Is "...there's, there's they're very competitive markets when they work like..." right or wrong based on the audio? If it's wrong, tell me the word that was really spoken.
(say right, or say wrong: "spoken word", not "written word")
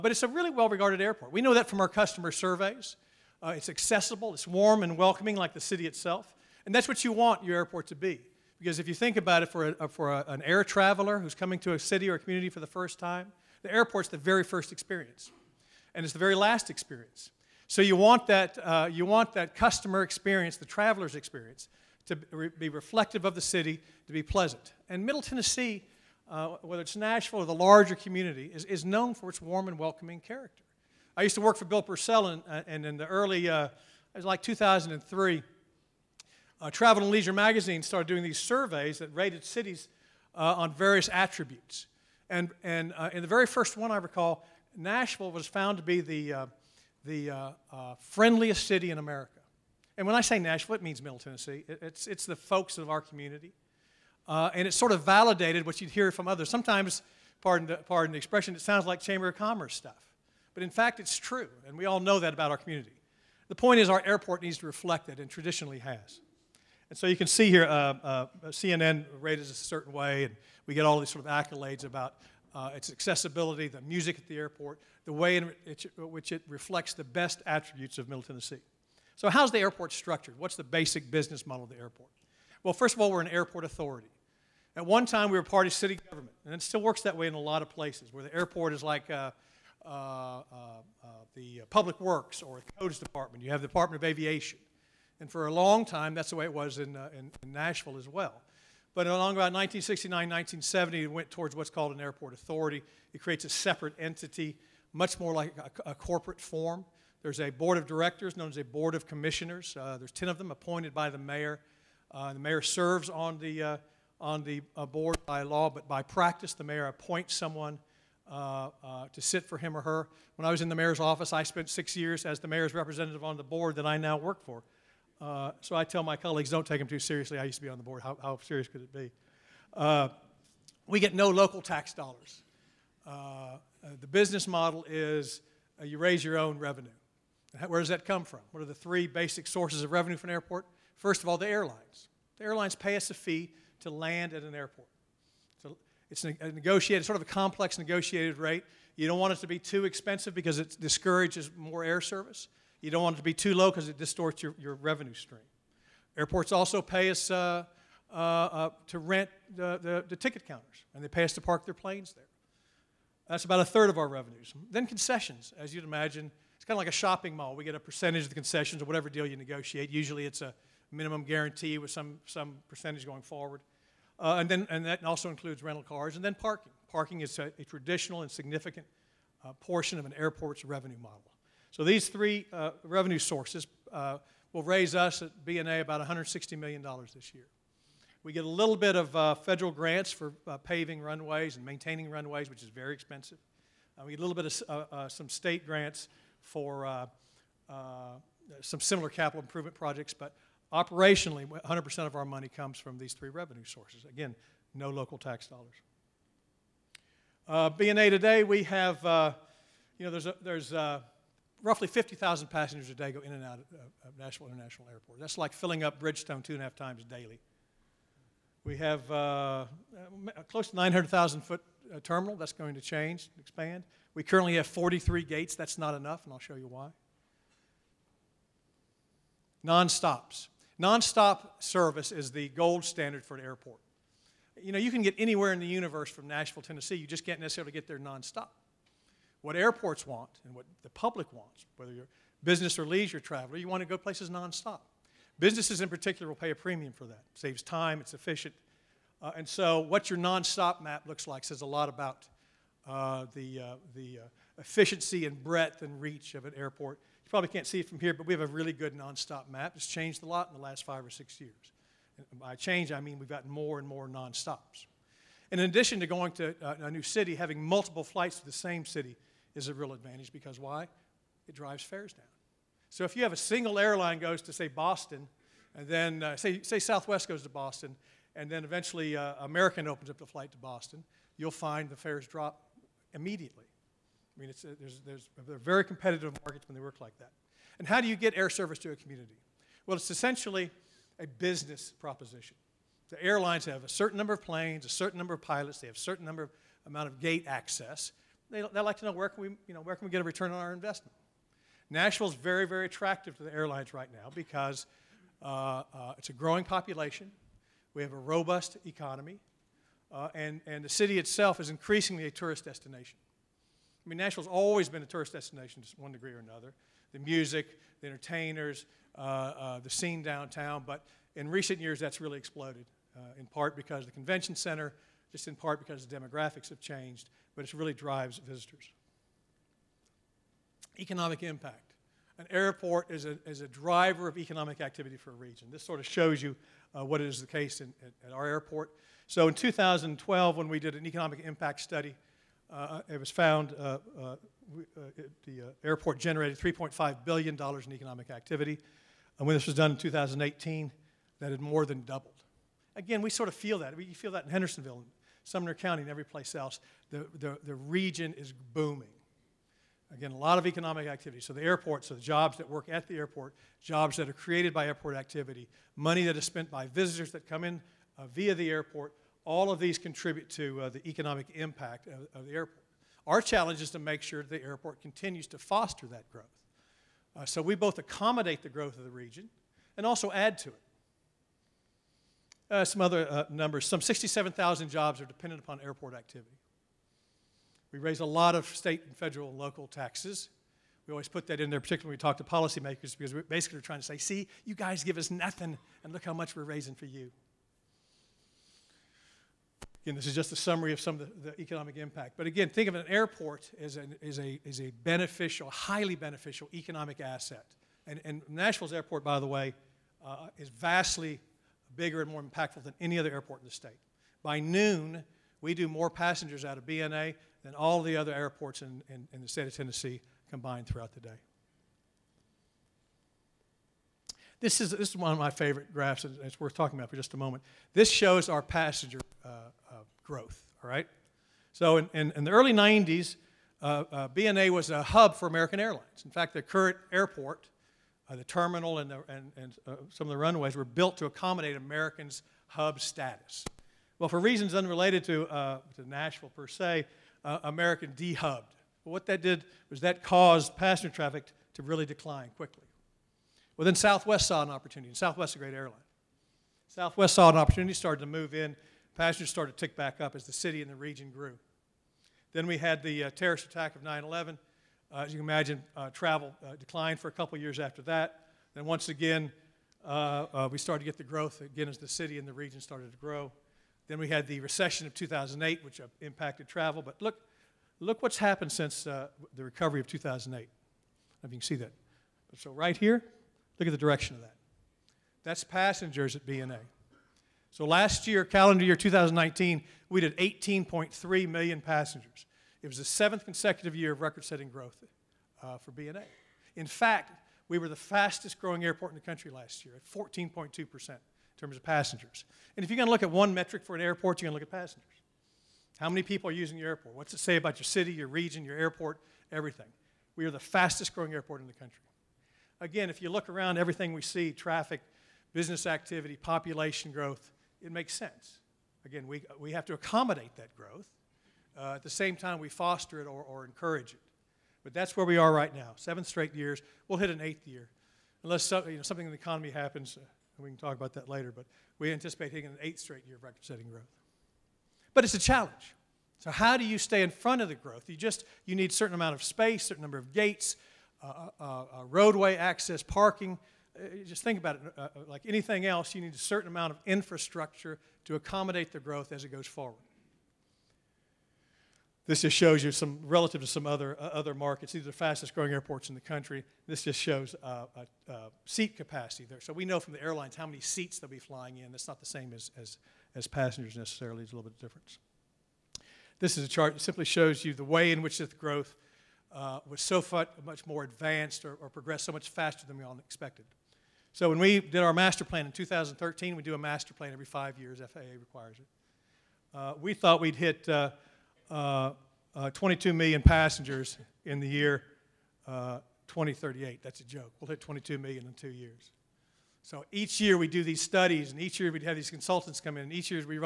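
right.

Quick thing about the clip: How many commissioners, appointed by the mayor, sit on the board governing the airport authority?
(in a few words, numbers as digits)
10.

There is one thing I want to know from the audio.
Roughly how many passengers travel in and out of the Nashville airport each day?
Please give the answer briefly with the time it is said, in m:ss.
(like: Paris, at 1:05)
50,000, at 3:31.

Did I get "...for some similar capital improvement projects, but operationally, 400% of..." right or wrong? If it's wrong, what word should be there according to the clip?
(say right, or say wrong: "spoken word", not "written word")
wrong: "100", not "400".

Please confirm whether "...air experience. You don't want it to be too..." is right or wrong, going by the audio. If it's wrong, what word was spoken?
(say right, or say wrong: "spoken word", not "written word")
wrong: "service", not "experience".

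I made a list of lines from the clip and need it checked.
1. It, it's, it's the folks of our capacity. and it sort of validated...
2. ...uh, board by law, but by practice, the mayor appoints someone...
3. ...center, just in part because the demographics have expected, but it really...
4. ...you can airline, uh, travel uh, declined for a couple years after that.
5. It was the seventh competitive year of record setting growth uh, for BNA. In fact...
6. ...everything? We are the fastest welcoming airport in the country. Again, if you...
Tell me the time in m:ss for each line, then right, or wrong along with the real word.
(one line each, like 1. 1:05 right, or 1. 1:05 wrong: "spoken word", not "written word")
1. 0:51 wrong: "community", not "capacity"
2. 1:54 right
3. 5:24 wrong: "changed", not "expected"
4. 7:45 wrong: "imagine", not "airline"
5. 8:12 wrong: "consecutive", not "competitive"
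6. 8:29 wrong: "growing", not "welcoming".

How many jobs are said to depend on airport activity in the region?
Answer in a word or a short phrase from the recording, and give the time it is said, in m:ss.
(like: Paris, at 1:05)
67,000, at 6:24.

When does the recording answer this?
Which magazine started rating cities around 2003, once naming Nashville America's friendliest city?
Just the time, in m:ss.
0:36.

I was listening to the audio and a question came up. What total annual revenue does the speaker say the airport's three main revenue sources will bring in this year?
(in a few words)
$160 million.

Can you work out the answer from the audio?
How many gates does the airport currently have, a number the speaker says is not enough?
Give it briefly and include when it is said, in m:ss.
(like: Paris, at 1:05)
43, at 3:44.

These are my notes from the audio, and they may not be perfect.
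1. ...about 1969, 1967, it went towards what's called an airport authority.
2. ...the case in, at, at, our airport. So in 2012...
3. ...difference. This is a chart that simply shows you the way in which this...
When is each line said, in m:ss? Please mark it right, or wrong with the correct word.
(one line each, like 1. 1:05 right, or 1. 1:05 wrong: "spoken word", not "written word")
1. 1:39 wrong: "1970", not "1967"
2. 5:37 right
3. 9:24 right.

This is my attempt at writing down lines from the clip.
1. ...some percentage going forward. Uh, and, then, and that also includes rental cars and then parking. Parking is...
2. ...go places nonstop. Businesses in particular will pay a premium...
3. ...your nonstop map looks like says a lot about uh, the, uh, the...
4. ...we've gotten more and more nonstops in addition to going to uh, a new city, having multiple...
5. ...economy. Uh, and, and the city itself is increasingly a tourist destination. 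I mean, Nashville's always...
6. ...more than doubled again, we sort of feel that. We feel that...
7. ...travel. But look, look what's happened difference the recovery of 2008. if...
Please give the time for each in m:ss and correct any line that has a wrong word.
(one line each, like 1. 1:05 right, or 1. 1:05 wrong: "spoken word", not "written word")
1. 2:52 right
2. 4:03 right
3. 4:10 right
4. 4:23 right
5. 5:08 right
6. 5:51 right
7. 7:56 wrong: "since", not "difference".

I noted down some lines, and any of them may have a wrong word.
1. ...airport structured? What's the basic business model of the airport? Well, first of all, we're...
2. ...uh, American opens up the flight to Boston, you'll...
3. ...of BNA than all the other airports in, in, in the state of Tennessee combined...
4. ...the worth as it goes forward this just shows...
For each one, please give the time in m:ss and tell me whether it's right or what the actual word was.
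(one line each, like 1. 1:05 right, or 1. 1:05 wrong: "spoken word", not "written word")
1. 1:19 right
2. 4:39 right
3. 6:56 right
4. 9:08 wrong: "growth", not "worth".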